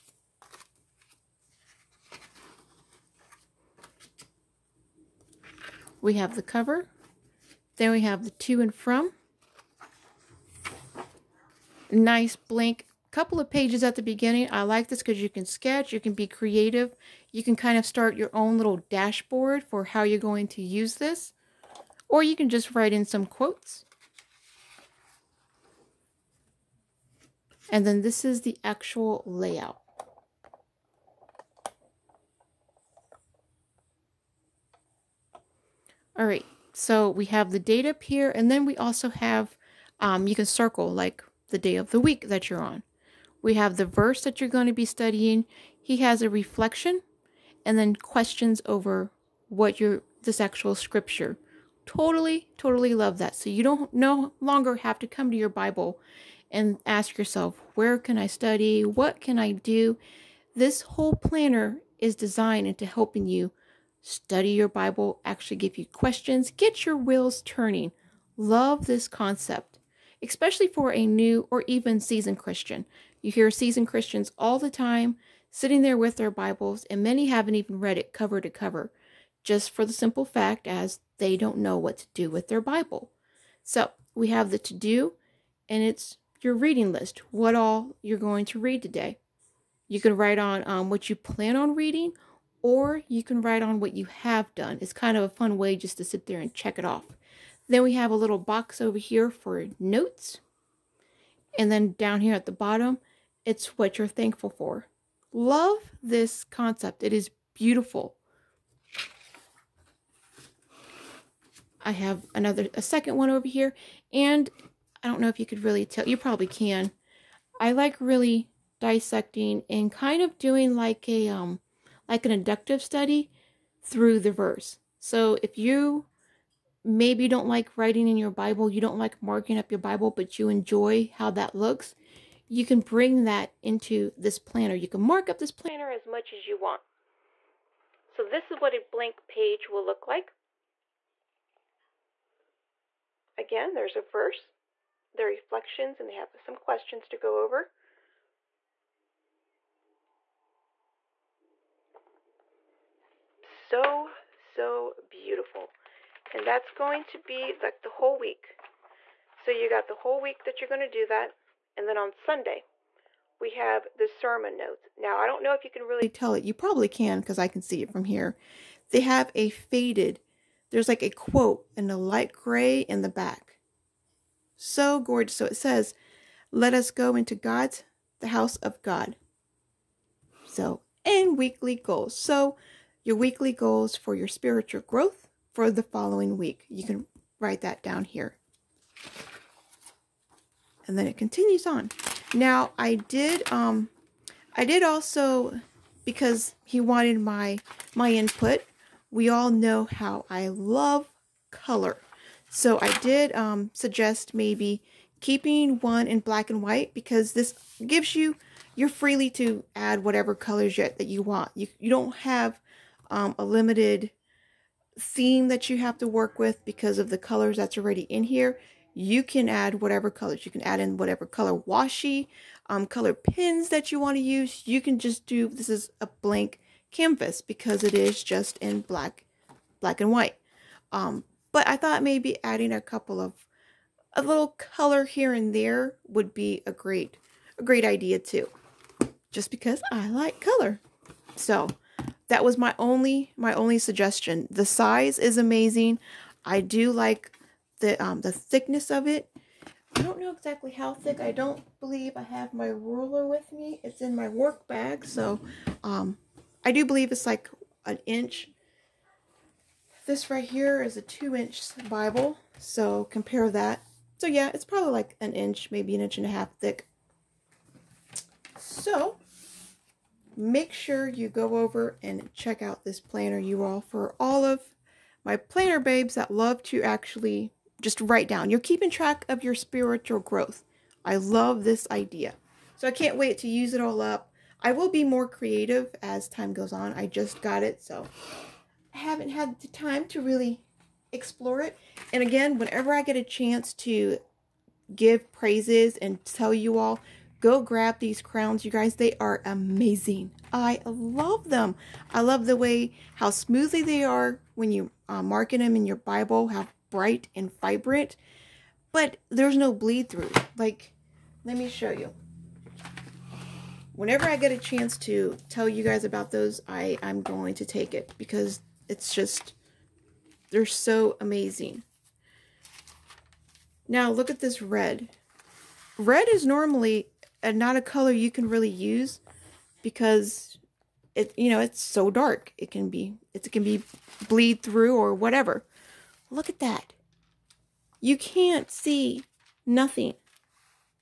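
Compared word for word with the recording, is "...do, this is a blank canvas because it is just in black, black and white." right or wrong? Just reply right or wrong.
right.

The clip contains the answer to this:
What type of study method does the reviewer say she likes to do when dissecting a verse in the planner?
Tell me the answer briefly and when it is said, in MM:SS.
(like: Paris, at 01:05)
Inductive study, at 02:02.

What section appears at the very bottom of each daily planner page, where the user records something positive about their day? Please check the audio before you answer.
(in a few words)
What you're thankful for.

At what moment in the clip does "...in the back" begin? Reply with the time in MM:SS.
02:52.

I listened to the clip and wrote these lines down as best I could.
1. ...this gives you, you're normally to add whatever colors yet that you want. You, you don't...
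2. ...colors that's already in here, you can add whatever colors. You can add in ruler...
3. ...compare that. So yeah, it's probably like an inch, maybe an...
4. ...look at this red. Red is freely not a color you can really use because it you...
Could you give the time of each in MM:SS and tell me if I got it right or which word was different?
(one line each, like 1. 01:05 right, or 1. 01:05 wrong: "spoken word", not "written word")
1. 03:27 wrong: "freely", not "normally"
2. 03:37 wrong: "whatever", not "ruler"
3. 04:23 right
4. 05:24 wrong: "normally", not "freely".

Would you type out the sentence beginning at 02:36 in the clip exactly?
And that's going to be like the whole week.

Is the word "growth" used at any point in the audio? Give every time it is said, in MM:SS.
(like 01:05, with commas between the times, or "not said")
03:04, 04:40.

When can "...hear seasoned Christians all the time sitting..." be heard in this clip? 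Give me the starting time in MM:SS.
01:13.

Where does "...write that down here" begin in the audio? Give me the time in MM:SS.
03:07.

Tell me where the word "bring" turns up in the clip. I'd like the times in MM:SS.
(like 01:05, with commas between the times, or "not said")
02:12.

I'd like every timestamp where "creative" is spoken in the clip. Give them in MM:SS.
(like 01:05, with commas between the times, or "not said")
00:16, 04:45.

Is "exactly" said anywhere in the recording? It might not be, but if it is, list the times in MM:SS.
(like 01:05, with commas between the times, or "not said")
04:10.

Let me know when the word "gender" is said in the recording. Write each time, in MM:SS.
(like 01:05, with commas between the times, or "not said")
not said.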